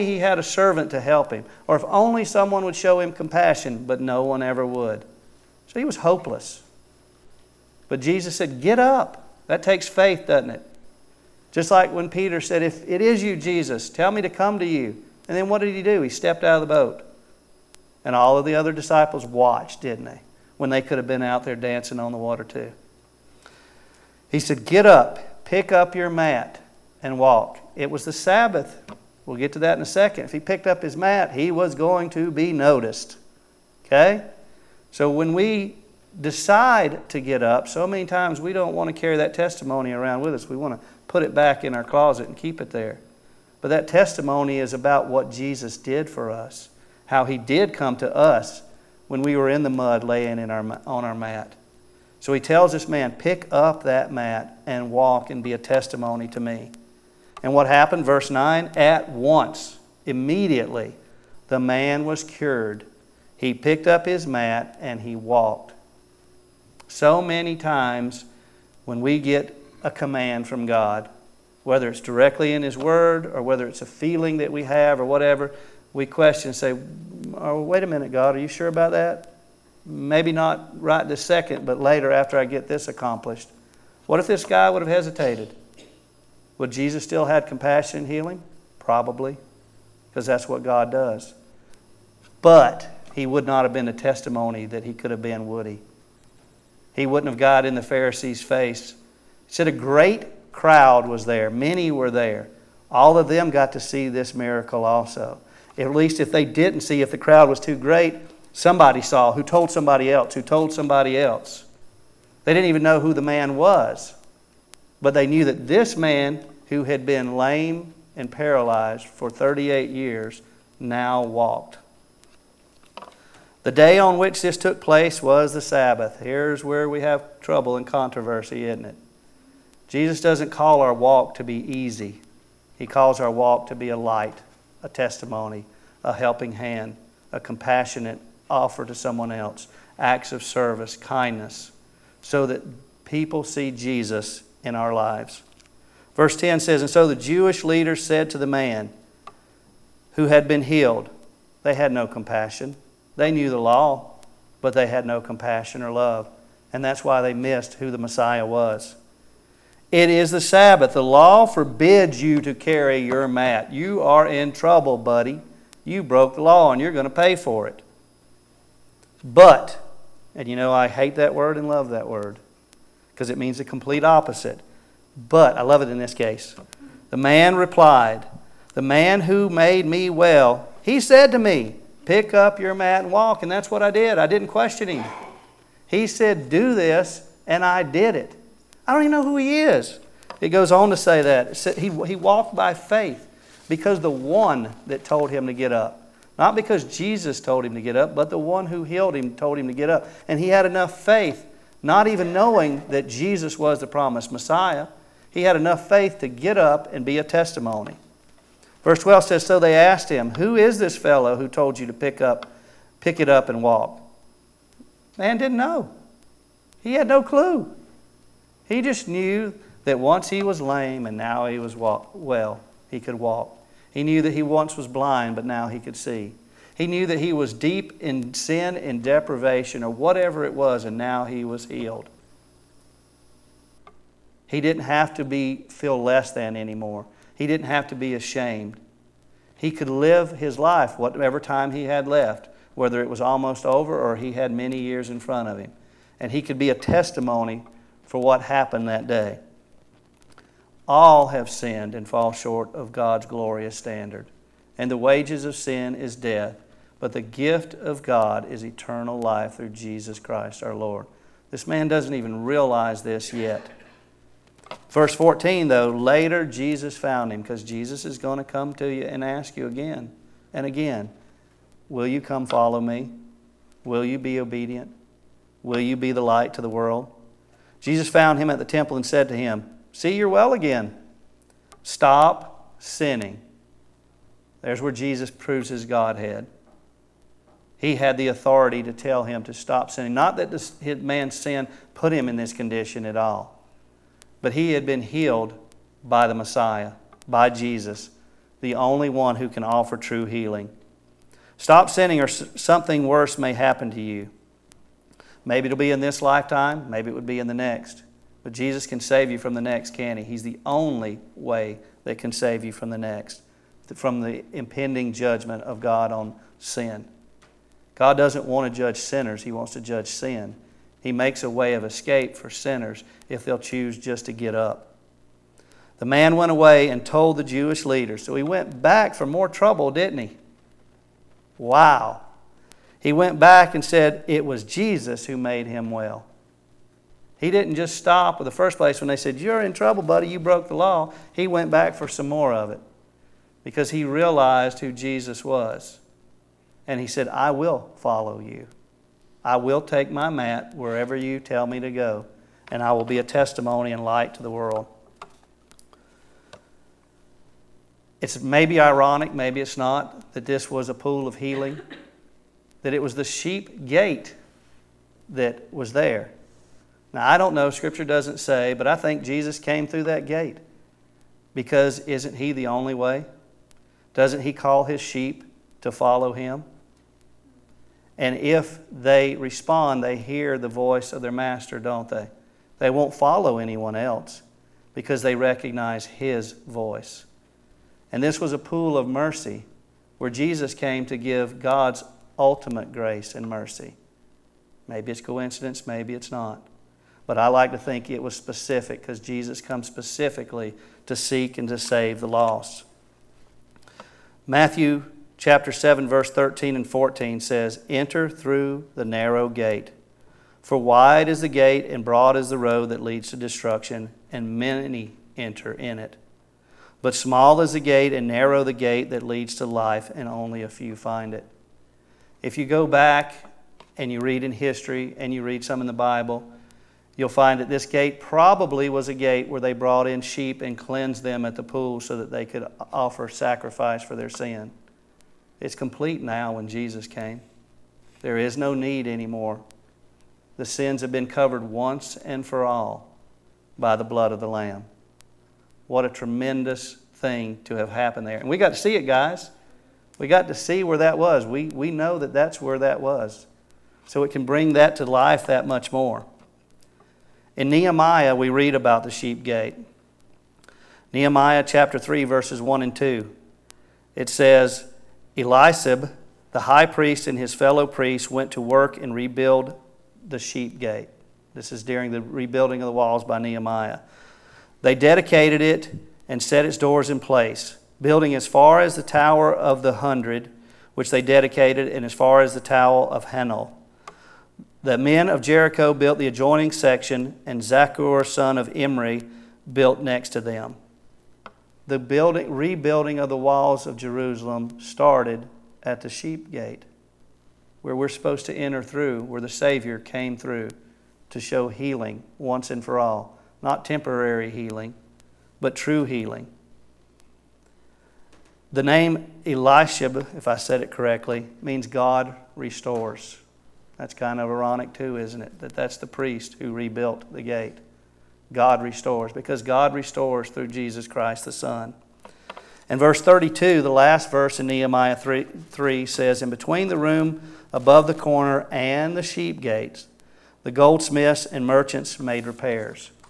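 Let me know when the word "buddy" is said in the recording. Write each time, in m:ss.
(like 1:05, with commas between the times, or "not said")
2:44, 5:40.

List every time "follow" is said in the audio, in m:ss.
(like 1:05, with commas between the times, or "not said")
4:32, 5:47, 6:15, 6:23.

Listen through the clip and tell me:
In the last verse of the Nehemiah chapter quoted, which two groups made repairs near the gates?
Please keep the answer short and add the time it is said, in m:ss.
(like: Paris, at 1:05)
Goldsmiths and merchants, at 8:50.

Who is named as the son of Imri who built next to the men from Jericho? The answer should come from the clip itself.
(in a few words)
Zakkur.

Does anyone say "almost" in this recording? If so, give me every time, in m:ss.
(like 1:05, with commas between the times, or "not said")
4:03.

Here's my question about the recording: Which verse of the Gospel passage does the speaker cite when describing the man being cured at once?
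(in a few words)
Verse 9.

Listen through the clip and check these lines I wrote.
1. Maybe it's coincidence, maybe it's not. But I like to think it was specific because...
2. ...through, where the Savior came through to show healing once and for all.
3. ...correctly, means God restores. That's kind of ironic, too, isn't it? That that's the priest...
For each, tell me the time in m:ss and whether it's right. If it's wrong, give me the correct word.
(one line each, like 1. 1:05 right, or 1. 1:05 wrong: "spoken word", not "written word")
1. 6:34 right
2. 8:18 right
3. 8:30 right.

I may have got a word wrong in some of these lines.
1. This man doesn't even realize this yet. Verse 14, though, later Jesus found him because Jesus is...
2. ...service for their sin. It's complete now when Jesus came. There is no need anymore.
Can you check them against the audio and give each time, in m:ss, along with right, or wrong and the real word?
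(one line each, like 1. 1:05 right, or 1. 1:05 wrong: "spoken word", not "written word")
1. 4:21 right
2. 7:13 wrong: "sacrifice", not "service".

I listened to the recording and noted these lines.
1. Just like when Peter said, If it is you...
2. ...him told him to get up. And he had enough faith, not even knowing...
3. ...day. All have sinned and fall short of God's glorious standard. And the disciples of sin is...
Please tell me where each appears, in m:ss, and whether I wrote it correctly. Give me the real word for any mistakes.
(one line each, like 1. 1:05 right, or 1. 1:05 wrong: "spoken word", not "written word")
1. 0:11 right
2. 3:19 right
3. 4:09 wrong: "wages", not "disciples".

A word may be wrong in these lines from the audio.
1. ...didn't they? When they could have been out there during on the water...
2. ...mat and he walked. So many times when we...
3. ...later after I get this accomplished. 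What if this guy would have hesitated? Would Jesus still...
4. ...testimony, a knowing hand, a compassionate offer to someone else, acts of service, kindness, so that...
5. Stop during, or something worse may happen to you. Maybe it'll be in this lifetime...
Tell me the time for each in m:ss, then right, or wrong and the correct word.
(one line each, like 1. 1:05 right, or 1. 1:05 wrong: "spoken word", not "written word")
1. 0:19 wrong: "dancing", not "during"
2. 1:04 right
3. 1:21 right
4. 2:14 wrong: "helping", not "knowing"
5. 5:01 wrong: "sinning", not "during".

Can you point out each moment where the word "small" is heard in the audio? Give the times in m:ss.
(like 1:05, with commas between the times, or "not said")
6:57.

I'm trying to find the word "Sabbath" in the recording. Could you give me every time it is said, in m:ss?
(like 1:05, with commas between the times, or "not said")
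0:28, 2:05, 2:40.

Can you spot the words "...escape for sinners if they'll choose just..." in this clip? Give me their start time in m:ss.
5:21.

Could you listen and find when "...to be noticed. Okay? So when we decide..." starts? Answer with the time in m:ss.
0:32.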